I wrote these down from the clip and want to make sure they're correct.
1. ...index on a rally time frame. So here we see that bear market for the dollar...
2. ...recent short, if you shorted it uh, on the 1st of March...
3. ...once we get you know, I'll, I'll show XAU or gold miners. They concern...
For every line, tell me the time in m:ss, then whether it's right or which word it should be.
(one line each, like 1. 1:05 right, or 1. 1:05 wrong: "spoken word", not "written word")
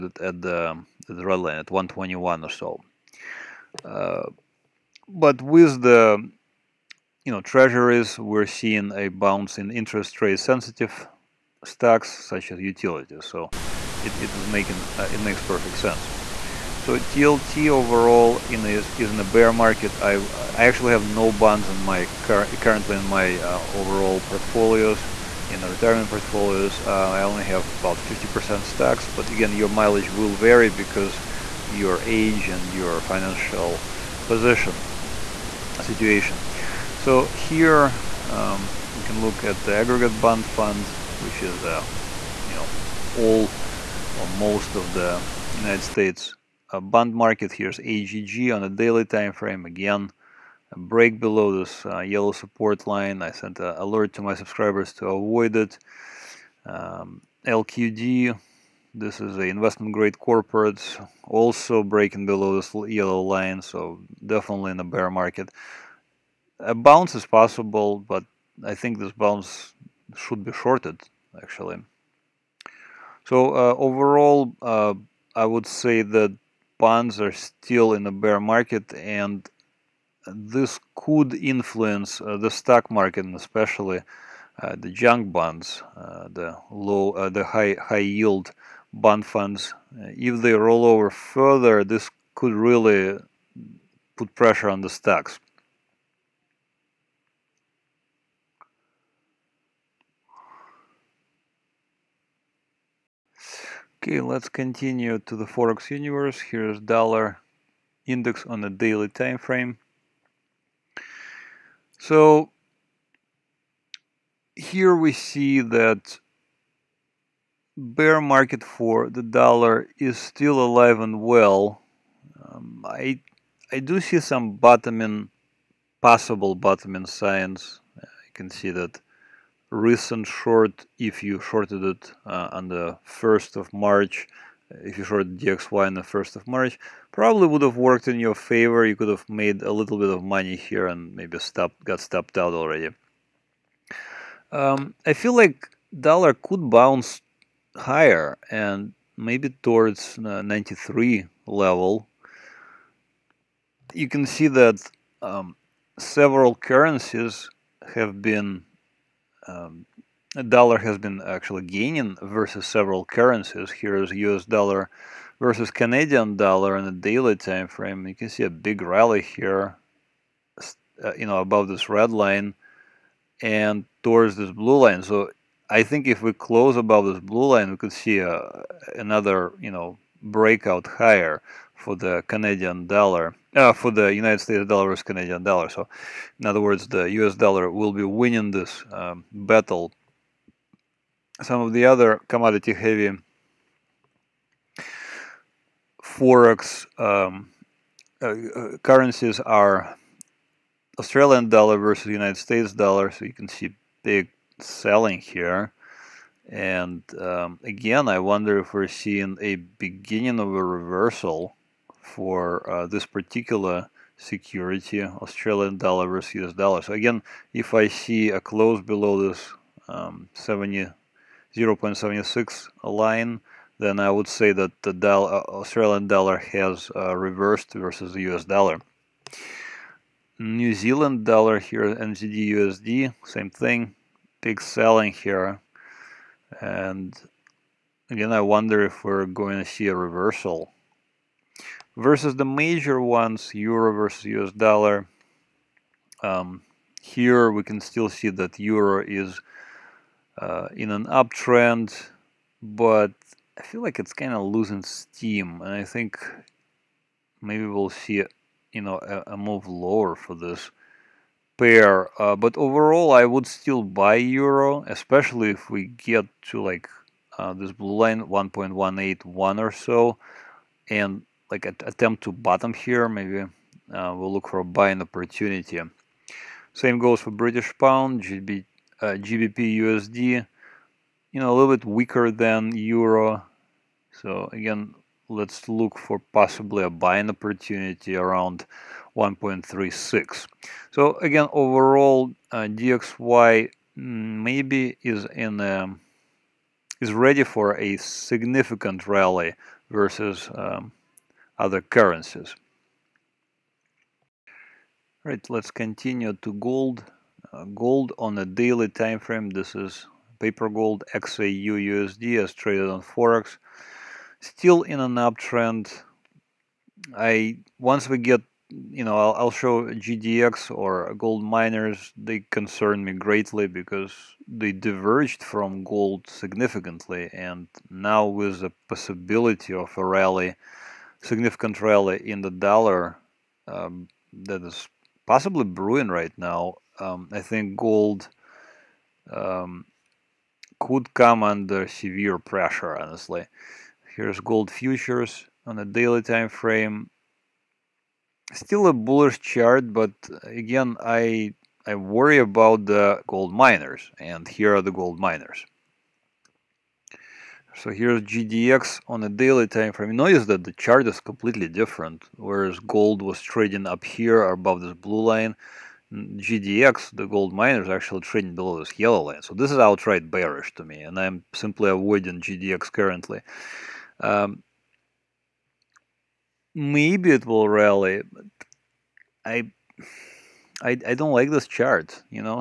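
1. 1:48 wrong: "daily", not "rally"
2. 2:09 right
3. 5:17 wrong: "GDX", not "XAU".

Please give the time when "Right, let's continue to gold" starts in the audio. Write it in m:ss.
5:05.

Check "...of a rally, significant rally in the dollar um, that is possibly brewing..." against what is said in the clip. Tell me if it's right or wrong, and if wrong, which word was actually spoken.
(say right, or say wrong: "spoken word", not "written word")
right.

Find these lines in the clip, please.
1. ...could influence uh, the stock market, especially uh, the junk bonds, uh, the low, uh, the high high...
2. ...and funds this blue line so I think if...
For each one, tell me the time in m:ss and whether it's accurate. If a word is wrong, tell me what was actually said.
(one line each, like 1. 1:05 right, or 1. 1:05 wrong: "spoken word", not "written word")
1. 1:20 right
2. 2:53 wrong: "towards", not "funds".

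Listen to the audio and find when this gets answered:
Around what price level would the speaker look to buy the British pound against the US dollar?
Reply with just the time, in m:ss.
4:49.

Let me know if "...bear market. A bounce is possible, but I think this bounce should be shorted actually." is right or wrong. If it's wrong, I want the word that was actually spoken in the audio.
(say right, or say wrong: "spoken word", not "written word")
right.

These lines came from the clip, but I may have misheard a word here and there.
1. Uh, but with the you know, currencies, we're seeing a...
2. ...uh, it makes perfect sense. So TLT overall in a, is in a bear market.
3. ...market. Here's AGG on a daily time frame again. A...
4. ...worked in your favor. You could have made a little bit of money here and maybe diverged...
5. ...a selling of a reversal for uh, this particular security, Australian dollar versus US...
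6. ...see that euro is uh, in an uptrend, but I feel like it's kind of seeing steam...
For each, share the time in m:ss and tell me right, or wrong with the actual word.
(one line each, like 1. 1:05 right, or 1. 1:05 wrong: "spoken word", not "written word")
1. 0:03 wrong: "treasuries", not "currencies"
2. 0:14 right
3. 0:47 right
4. 2:17 wrong: "stopped", not "diverged"
5. 3:29 wrong: "beginning", not "selling"
6. 4:08 wrong: "losing", not "seeing".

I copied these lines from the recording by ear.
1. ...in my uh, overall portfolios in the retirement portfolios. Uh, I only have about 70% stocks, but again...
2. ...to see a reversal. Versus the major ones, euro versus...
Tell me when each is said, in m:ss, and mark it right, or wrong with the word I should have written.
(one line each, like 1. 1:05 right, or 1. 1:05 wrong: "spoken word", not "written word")
1. 0:22 wrong: "50", not "70"
2. 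3:59 right.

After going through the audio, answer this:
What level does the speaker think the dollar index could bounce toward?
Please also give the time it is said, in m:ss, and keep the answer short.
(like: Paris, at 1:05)
93, at 2:30.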